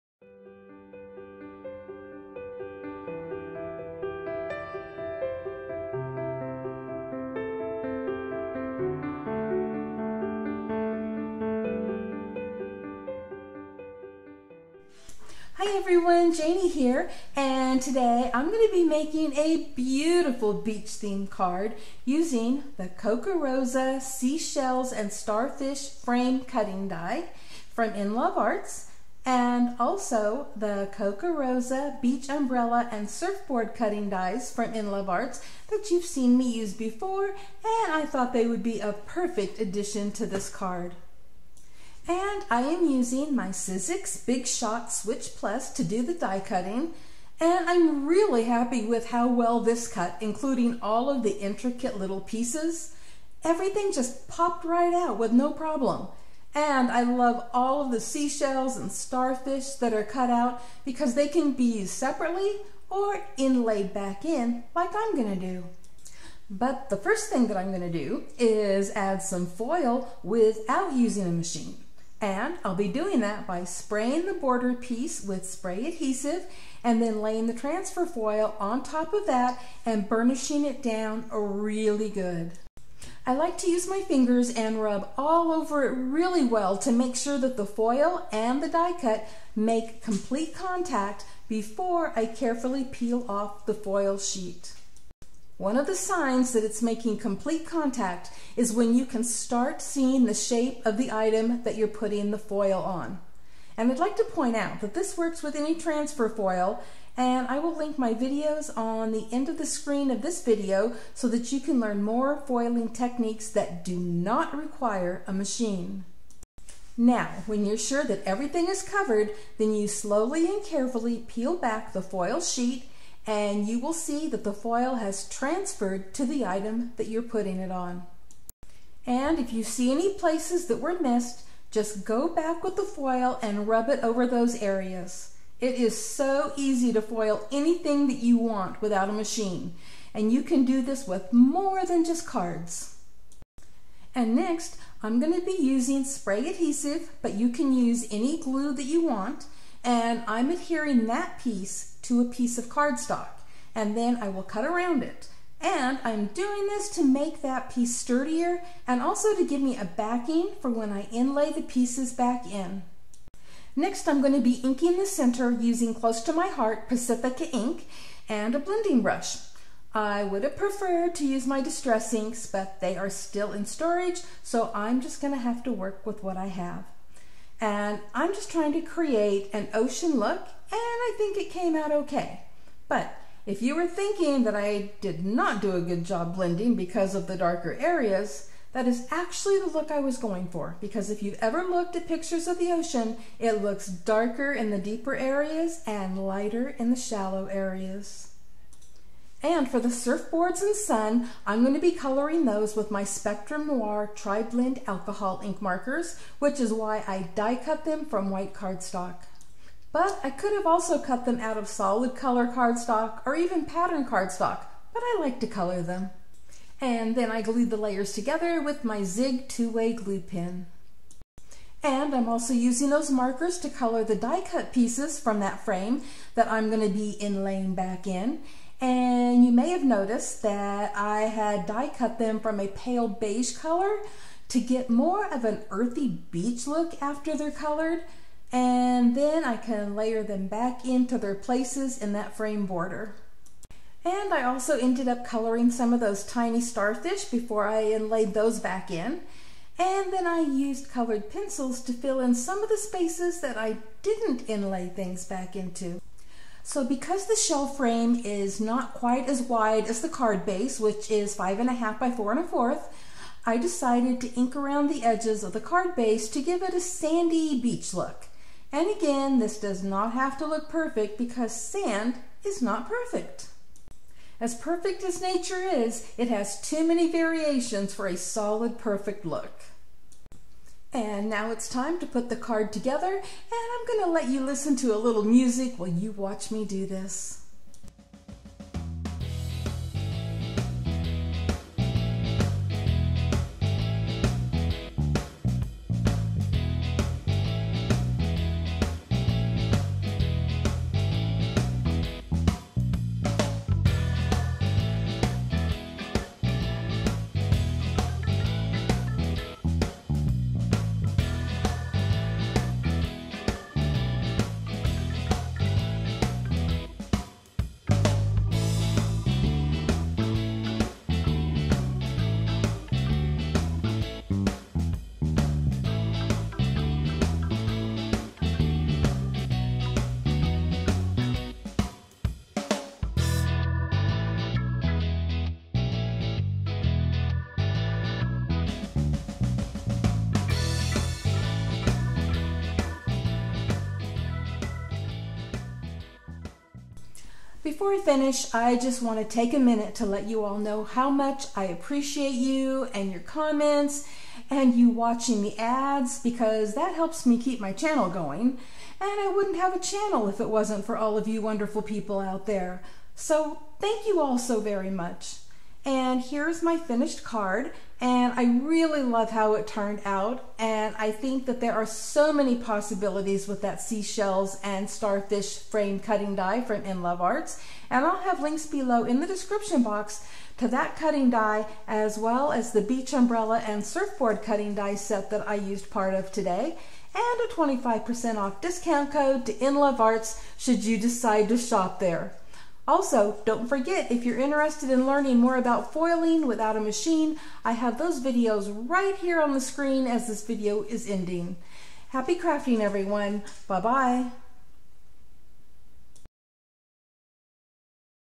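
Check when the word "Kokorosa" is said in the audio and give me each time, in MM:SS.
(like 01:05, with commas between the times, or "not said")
00:22, 00:30.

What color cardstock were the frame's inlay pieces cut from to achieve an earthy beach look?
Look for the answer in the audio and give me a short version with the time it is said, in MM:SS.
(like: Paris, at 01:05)
pale beige, at 03:52.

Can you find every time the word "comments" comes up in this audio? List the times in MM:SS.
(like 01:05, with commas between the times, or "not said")
05:53.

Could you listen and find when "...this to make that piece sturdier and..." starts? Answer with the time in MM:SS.
02:36.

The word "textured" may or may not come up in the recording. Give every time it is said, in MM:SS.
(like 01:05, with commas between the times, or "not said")
not said.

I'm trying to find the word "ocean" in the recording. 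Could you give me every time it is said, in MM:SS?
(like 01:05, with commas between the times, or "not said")
02:59, 03:12.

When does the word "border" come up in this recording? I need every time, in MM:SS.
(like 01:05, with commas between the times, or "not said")
01:14, 04:02.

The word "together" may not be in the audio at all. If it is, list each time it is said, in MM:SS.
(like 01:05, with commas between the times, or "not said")
03:38, 04:42.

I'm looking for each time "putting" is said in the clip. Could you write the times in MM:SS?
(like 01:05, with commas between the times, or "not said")
01:42, 02:07.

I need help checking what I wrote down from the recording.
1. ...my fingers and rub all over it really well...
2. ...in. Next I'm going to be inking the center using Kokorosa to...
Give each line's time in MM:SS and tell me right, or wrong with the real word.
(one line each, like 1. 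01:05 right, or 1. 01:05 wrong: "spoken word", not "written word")
1. 01:23 right
2. 02:42 wrong: "Close", not "Kokorosa".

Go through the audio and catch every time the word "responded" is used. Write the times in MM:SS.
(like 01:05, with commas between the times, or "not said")
not said.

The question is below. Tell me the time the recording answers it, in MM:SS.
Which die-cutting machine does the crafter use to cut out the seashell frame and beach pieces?
00:43.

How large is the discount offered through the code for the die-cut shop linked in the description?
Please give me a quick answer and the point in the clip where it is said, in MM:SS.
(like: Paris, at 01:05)
25%, at 06:27.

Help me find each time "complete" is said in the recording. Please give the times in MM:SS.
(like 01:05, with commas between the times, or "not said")
01:30, 01:37.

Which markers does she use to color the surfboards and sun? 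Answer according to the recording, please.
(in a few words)
Spectrum Noir Tri-Blend Alcohol ink markers.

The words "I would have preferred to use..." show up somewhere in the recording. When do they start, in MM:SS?
02:49.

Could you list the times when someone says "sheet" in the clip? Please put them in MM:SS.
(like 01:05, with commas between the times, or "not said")
01:34, 02:02.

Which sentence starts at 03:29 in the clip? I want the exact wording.
But I could have also cut them out of solid color cardstock or even pattern cardstock, but I like to color them.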